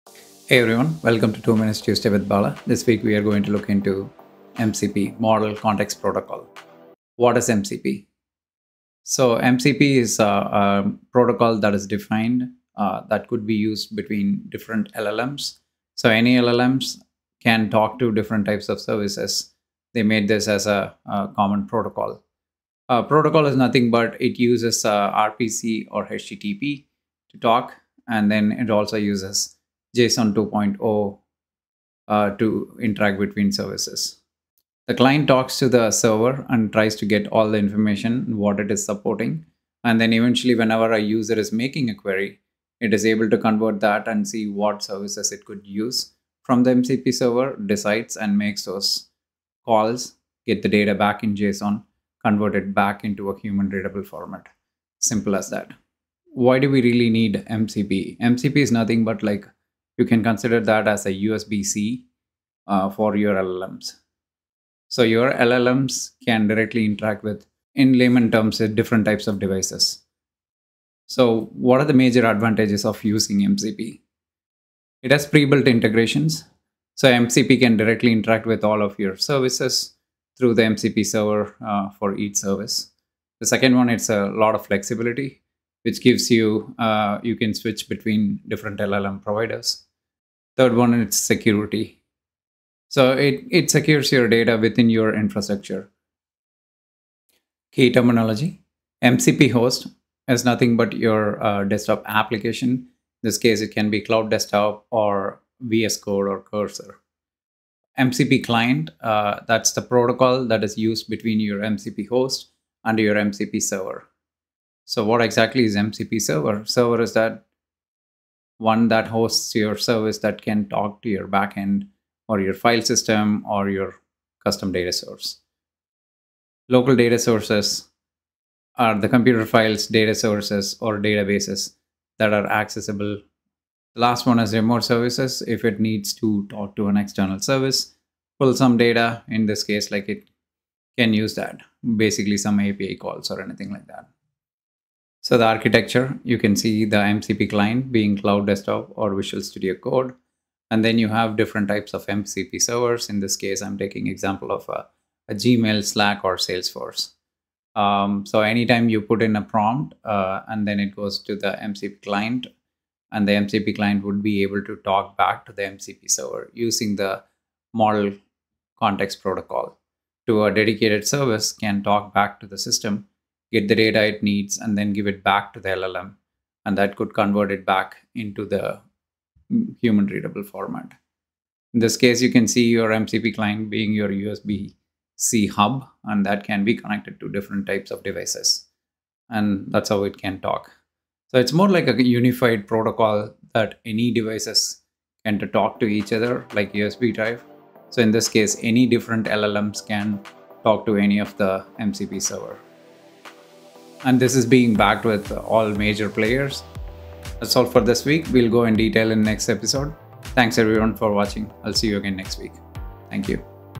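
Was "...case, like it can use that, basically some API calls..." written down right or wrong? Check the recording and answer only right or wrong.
right.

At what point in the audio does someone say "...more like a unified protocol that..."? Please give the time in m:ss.
3:11.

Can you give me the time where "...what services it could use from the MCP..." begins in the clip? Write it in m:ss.
0:44.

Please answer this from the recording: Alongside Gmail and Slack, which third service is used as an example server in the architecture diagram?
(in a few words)
Salesforce.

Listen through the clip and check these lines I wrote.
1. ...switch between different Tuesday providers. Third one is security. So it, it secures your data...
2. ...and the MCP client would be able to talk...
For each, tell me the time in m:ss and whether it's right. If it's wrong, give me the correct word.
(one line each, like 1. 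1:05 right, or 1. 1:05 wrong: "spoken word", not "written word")
1. 1:27 wrong: "LLM", not "Tuesday"
2. 2:43 right.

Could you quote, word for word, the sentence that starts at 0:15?
So any LLMs can talk to different types of services.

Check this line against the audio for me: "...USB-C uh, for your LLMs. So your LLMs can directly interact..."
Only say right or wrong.
right.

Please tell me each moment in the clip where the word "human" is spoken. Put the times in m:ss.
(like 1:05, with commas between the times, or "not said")
0:53, 2:59.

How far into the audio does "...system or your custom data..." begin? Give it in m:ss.
2:02.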